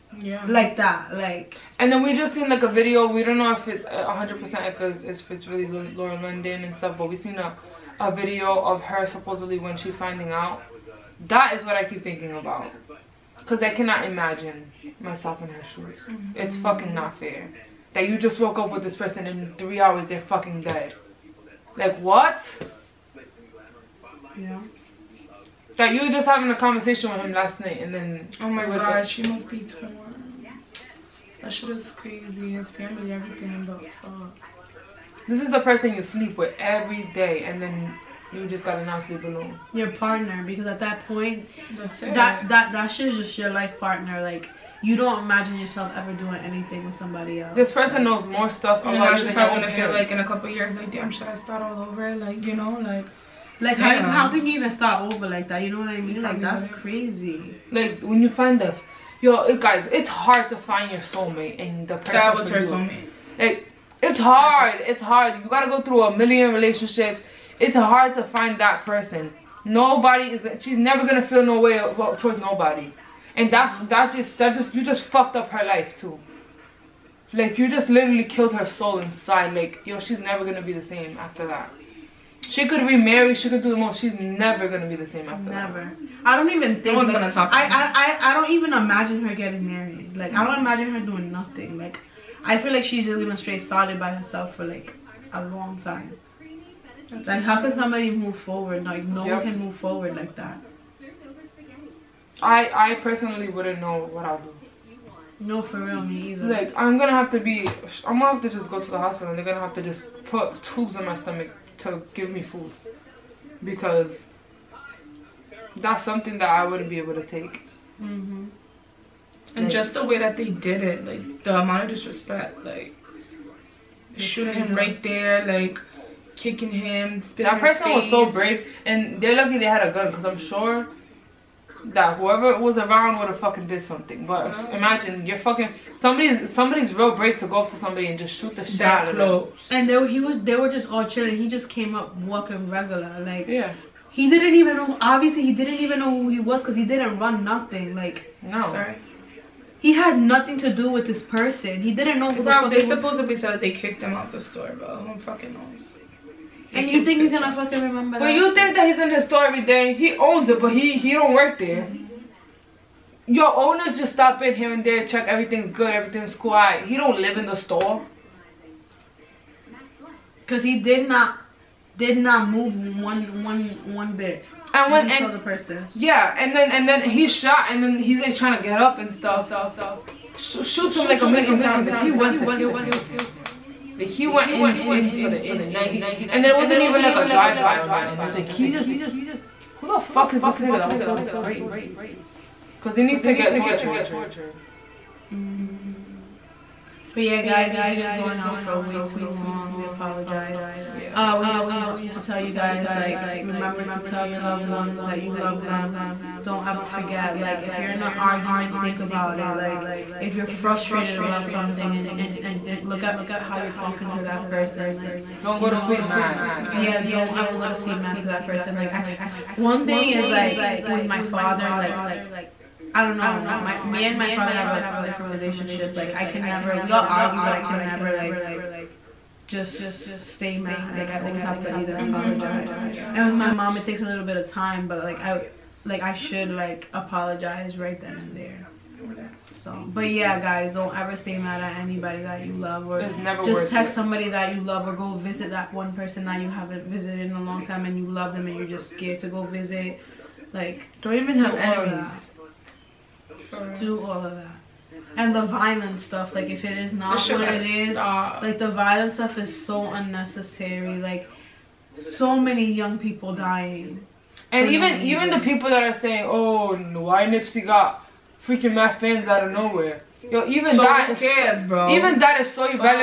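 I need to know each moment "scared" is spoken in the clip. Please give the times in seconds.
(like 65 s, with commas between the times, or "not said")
248 s.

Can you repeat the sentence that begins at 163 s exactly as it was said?
Your owners just stop in here and there, check everything's good, everything's quiet.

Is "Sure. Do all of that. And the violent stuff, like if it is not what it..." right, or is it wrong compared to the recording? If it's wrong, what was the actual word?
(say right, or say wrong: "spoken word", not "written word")
right.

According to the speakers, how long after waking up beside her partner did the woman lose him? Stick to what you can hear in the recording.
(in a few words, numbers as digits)
3 hours.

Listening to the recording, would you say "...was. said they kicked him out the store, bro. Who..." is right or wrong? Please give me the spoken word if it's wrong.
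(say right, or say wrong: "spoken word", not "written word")
right.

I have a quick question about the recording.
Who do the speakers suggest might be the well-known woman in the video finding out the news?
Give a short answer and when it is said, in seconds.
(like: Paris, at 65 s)
Lauren London, at 5 s.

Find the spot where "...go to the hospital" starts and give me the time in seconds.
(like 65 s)
108 s.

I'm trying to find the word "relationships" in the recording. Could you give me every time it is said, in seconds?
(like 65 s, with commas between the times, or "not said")
66 s, 225 s.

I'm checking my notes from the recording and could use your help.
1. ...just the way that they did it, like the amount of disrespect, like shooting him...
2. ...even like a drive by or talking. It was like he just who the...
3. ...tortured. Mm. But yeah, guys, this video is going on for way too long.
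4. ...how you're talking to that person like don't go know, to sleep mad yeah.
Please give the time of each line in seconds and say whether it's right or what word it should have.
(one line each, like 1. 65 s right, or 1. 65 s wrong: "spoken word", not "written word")
1. 119 s right
2. 186 s wrong: "nothing", not "talking"
3. 193 s right
4. 213 s right.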